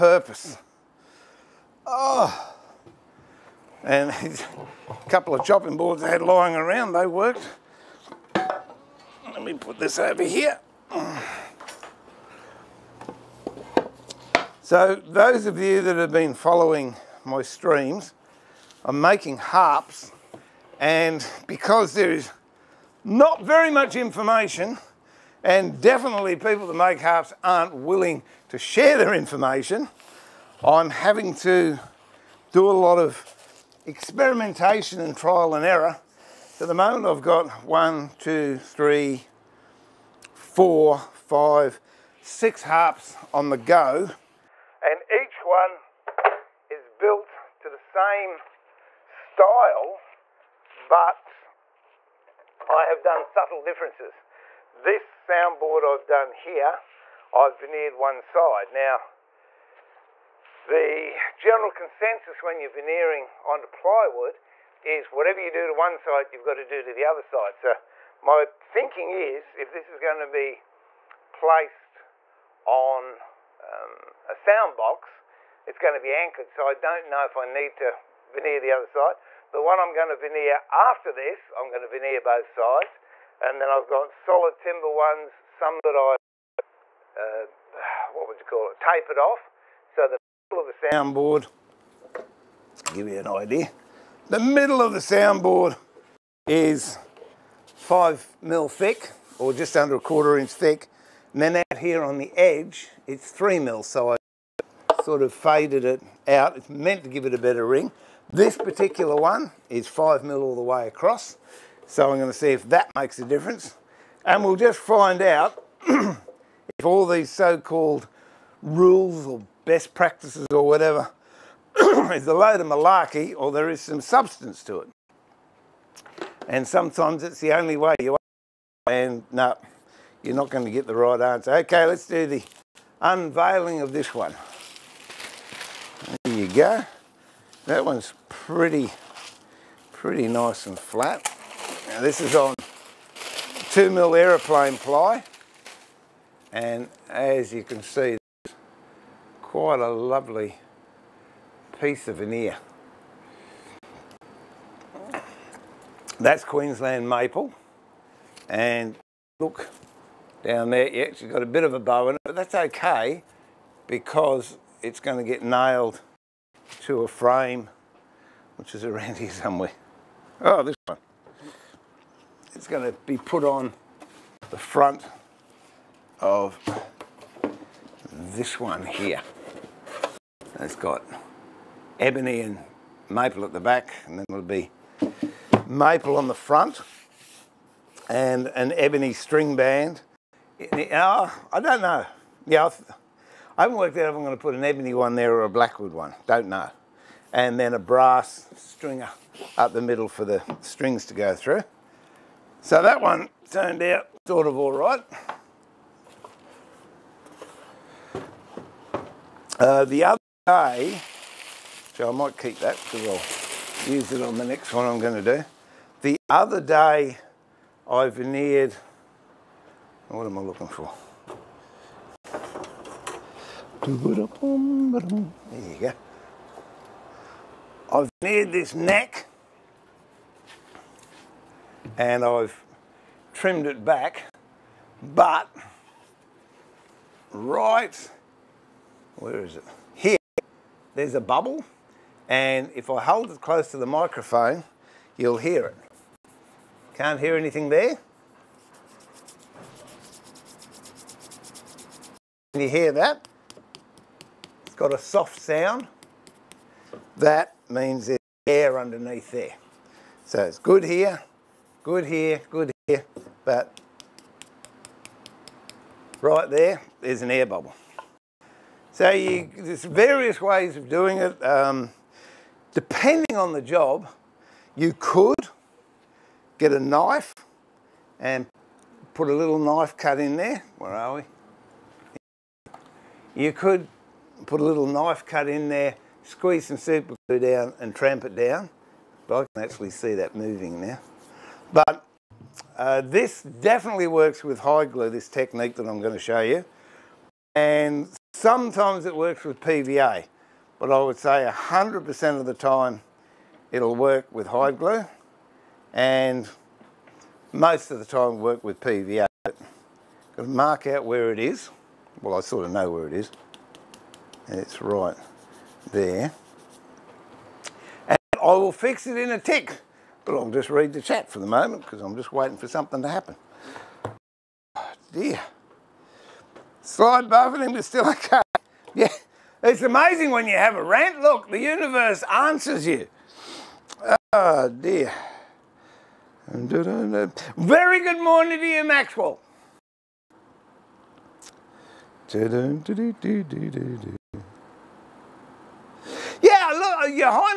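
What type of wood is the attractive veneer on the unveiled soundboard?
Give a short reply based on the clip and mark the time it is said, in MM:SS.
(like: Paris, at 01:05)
Queensland maple, at 02:36.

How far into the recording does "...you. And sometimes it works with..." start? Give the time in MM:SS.
04:56.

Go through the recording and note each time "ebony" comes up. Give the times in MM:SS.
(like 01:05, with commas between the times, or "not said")
03:01, 03:08, 03:14.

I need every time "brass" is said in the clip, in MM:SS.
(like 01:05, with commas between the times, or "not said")
03:17.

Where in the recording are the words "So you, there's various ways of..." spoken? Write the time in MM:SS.
04:28.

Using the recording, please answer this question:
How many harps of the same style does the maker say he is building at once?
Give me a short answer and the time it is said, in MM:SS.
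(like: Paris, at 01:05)
6, at 00:42.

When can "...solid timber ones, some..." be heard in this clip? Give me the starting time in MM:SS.
01:24.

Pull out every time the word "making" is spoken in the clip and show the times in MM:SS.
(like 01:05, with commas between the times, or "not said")
00:18.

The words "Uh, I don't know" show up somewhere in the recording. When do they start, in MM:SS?
03:10.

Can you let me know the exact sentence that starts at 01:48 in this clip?
This particular one is five mil all the way across.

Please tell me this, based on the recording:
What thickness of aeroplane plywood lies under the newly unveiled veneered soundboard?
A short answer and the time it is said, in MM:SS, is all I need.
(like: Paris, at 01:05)
2 mil, at 02:23.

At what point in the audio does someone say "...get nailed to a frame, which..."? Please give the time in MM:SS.
02:45.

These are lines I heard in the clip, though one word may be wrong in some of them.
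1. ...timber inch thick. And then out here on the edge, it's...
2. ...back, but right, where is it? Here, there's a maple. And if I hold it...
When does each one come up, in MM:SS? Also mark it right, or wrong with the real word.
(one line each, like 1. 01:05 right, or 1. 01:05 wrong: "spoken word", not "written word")
1. 01:39 wrong: "quarter", not "timber"
2. 03:53 wrong: "bubble", not "maple".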